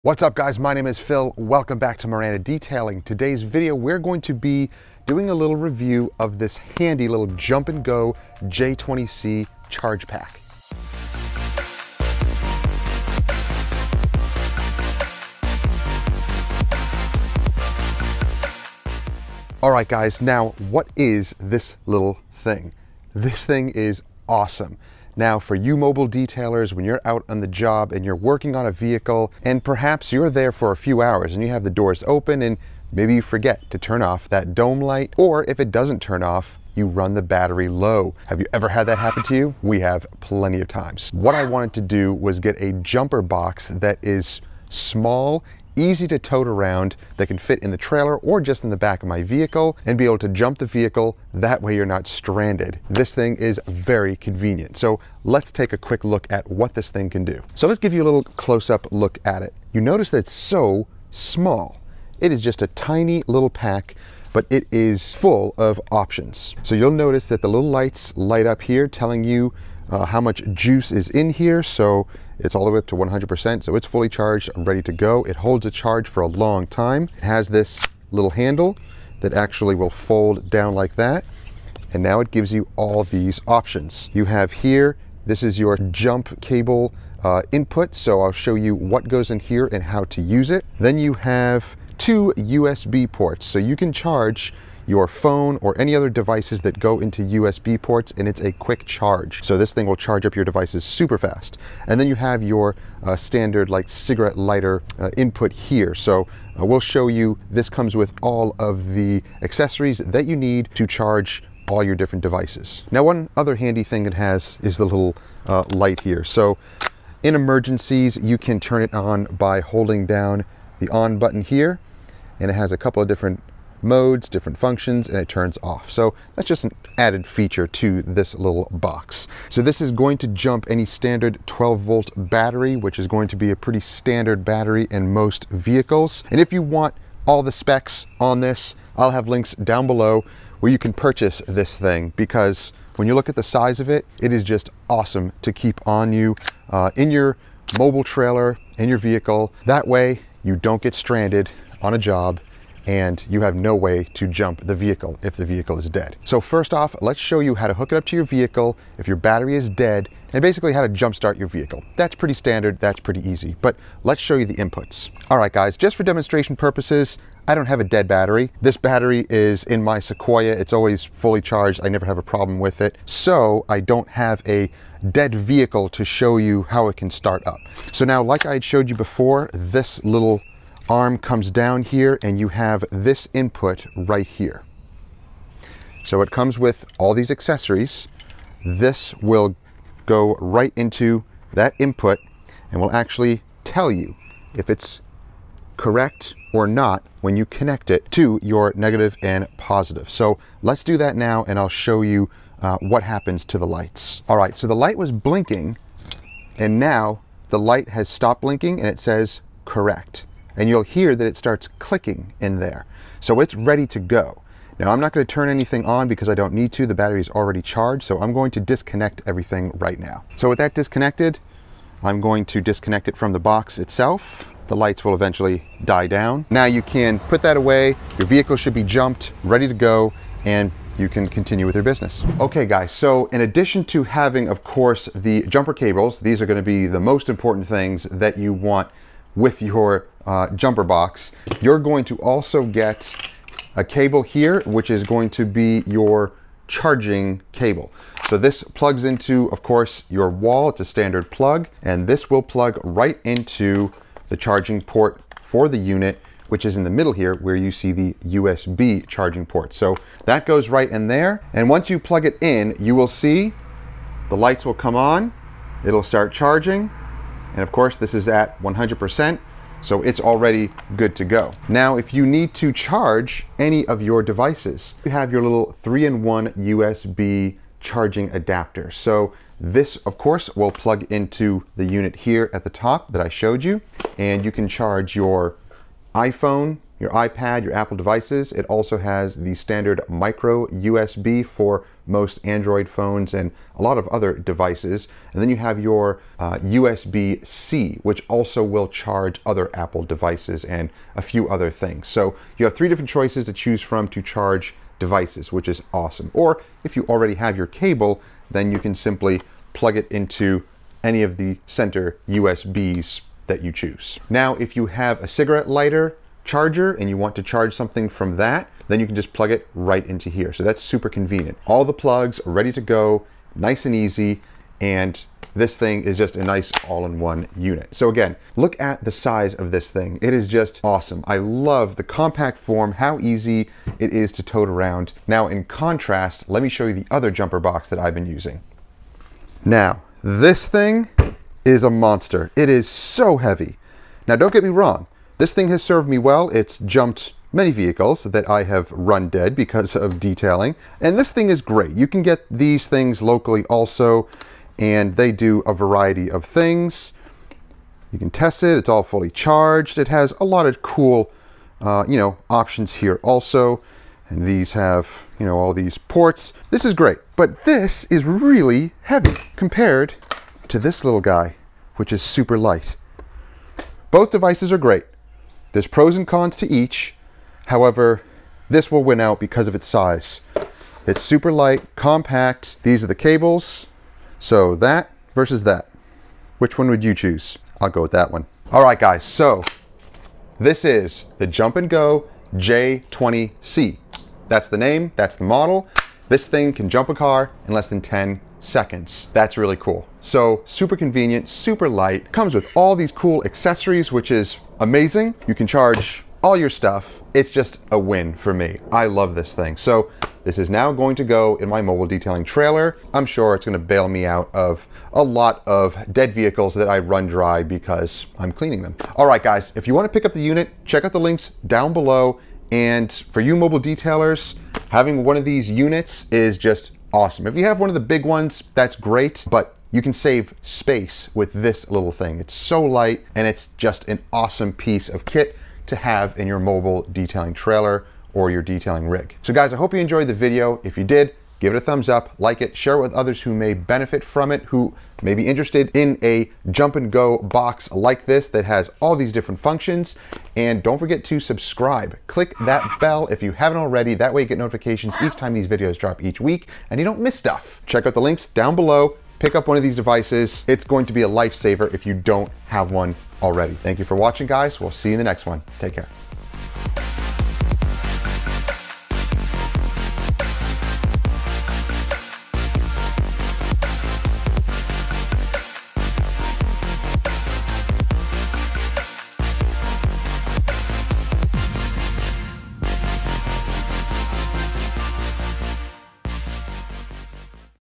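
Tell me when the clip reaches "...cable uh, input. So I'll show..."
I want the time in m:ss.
1:26.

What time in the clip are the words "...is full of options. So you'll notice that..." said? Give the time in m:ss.
1:04.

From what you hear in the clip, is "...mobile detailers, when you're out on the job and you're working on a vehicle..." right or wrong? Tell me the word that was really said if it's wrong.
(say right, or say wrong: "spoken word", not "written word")
right.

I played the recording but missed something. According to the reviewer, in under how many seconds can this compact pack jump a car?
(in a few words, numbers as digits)
10 seconds.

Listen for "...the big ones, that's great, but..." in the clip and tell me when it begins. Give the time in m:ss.
7:07.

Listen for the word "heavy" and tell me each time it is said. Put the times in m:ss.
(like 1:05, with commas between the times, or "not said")
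5:43, 6:09.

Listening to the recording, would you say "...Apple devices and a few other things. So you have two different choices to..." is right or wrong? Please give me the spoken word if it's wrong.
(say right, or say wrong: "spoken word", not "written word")
wrong: "three", not "two".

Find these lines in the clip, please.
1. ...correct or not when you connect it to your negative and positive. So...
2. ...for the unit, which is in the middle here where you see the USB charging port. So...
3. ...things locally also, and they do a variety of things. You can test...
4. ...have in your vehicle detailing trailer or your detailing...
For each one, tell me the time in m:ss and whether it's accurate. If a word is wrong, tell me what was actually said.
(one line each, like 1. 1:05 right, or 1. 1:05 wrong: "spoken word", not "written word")
1. 3:15 right
2. 4:15 right
3. 5:52 right
4. 7:15 wrong: "mobile", not "vehicle".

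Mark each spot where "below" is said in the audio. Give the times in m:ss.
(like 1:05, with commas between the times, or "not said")
2:19, 7:01, 7:38.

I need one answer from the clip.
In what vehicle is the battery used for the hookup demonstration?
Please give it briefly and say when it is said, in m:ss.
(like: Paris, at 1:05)
Sequoia, at 2:49.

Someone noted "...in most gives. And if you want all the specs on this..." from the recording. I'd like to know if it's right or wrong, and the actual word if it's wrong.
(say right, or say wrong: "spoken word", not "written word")
wrong: "vehicles", not "gives".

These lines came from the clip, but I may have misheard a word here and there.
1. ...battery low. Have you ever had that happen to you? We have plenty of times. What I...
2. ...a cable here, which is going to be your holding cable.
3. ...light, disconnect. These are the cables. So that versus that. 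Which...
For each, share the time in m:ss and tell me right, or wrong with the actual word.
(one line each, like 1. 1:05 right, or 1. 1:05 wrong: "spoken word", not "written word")
1. 0:37 right
2. 4:03 wrong: "charging", not "holding"
3. 6:21 wrong: "compact", not "disconnect".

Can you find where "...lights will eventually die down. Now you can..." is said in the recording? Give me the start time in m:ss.
3:44.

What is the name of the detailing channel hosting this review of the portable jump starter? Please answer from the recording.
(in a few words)
Miranda Detailing.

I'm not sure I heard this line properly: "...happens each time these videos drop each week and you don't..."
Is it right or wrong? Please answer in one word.
wrong.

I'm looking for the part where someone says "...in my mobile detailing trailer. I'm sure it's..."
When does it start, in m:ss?
6:51.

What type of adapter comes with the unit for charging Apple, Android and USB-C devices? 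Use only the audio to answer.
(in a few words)
three-in-one USB charging adapter.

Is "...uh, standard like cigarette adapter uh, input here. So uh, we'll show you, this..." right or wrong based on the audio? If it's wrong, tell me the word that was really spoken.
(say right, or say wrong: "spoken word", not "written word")
wrong: "lighter", not "adapter".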